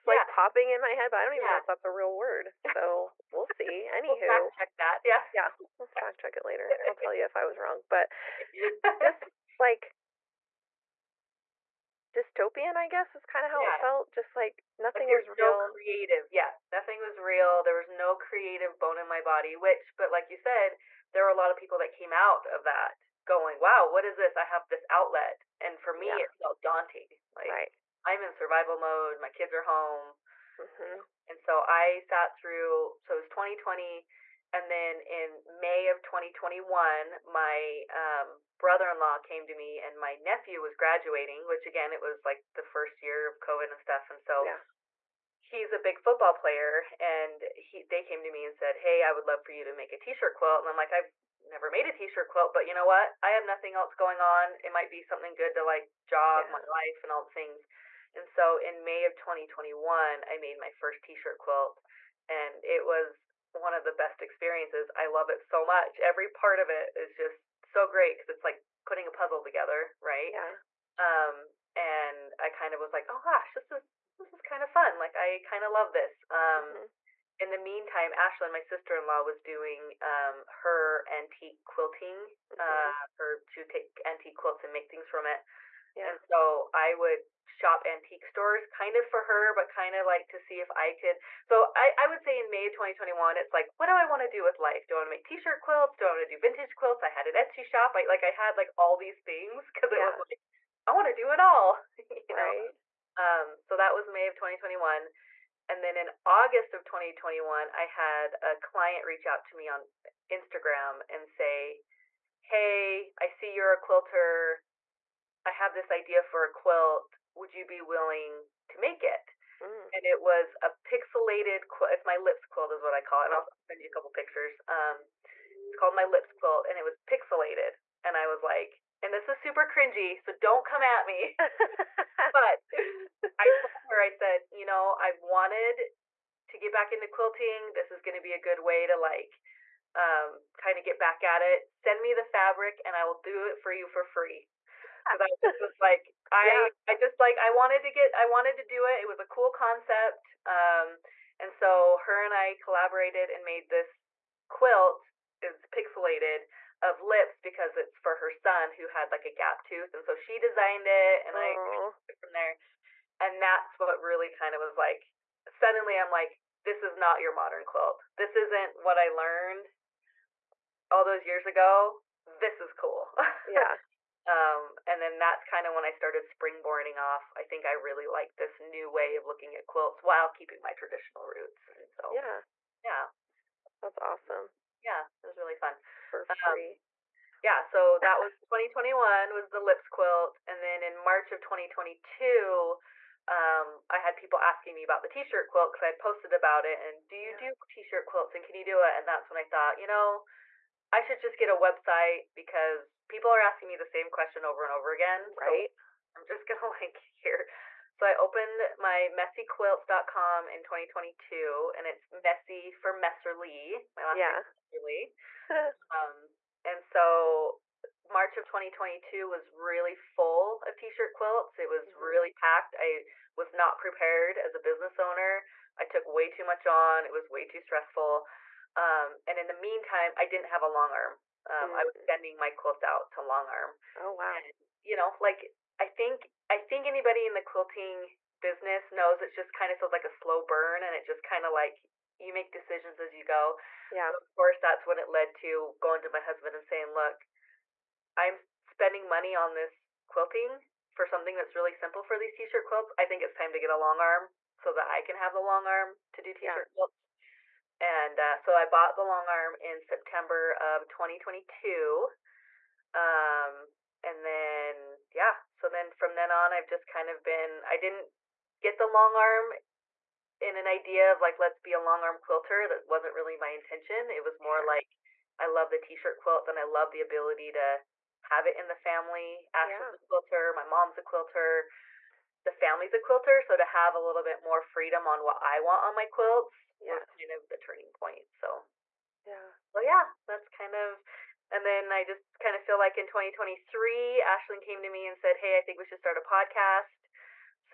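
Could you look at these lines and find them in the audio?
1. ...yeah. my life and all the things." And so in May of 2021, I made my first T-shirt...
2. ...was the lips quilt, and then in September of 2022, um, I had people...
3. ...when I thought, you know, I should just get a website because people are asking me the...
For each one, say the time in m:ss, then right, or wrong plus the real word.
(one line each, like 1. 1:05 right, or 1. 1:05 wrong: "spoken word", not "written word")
1. 0:56 right
2. 3:09 wrong: "March", not "September"
3. 3:19 right.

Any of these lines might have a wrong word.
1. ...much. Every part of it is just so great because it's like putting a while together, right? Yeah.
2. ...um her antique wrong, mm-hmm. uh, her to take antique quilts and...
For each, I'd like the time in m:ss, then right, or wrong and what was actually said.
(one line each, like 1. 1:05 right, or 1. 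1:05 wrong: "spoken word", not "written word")
1. 1:05 wrong: "puzzle", not "while"
2. 1:20 wrong: "quilting", not "wrong".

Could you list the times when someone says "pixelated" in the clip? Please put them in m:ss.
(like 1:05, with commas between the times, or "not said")
2:00, 2:07, 2:35.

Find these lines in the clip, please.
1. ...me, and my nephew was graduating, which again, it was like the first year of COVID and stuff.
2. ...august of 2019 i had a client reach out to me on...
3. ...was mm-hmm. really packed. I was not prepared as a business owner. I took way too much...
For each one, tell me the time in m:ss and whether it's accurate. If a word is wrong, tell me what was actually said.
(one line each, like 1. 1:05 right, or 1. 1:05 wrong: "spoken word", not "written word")
1. 0:39 right
2. 1:46 wrong: "2021", not "2019"
3. 3:41 right.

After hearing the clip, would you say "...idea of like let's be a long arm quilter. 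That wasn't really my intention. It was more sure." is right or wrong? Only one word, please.
right.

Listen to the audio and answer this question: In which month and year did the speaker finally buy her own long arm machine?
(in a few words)
September 2022.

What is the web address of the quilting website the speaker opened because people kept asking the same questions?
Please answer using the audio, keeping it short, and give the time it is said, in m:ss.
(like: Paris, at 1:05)
messyquilts.com, at 3:29.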